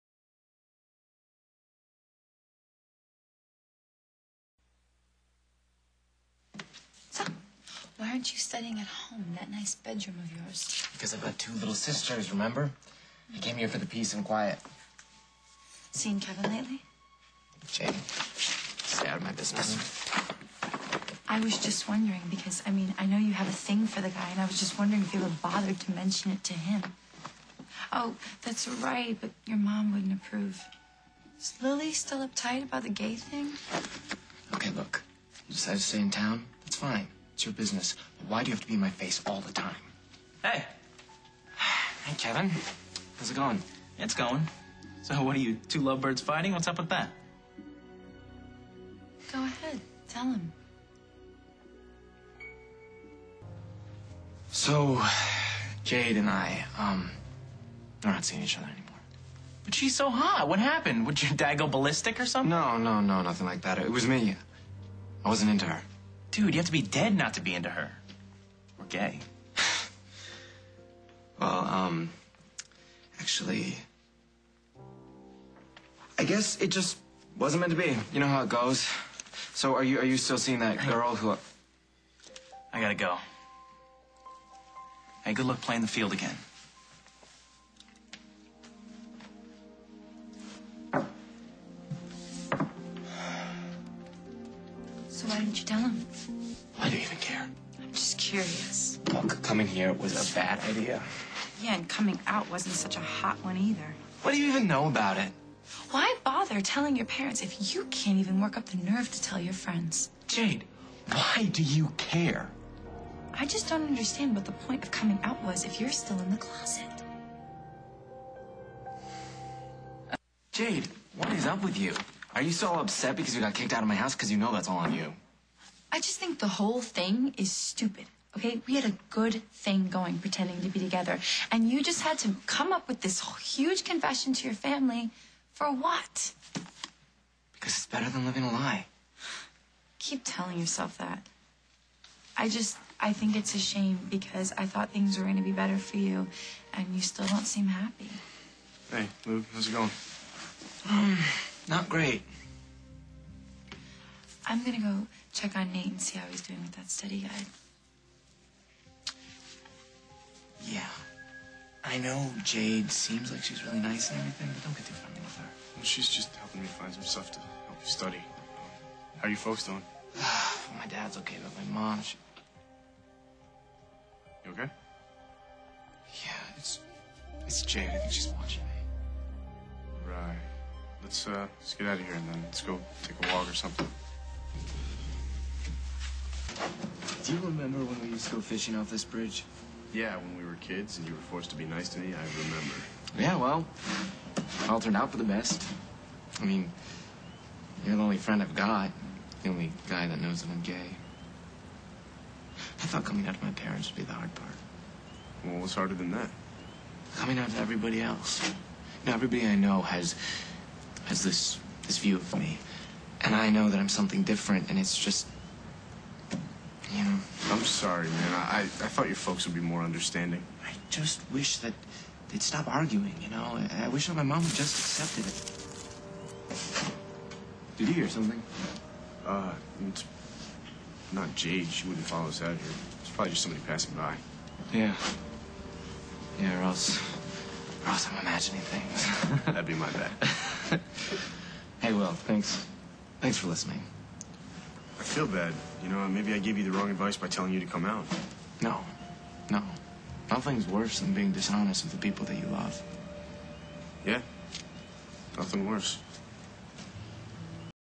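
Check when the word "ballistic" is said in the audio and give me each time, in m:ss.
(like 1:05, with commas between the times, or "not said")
1:01.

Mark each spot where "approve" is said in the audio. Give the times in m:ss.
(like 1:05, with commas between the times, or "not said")
0:30.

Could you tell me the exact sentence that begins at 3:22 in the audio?
I thought coming out to my parents would be the hard part.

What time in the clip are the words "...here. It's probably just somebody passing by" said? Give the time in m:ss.
3:52.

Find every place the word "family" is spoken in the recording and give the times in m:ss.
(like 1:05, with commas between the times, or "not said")
2:14.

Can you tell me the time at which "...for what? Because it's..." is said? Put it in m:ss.
2:15.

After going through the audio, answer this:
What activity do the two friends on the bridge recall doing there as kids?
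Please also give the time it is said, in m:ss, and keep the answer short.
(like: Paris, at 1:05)
Fishing, at 3:08.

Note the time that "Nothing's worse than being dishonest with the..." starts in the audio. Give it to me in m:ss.
4:10.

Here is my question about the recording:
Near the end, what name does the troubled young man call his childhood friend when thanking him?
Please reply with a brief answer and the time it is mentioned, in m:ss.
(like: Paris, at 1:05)
Will, at 4:01.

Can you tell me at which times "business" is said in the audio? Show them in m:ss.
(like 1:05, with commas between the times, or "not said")
0:19, 0:37.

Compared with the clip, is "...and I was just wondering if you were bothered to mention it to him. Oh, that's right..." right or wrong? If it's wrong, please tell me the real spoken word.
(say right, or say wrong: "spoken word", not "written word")
right.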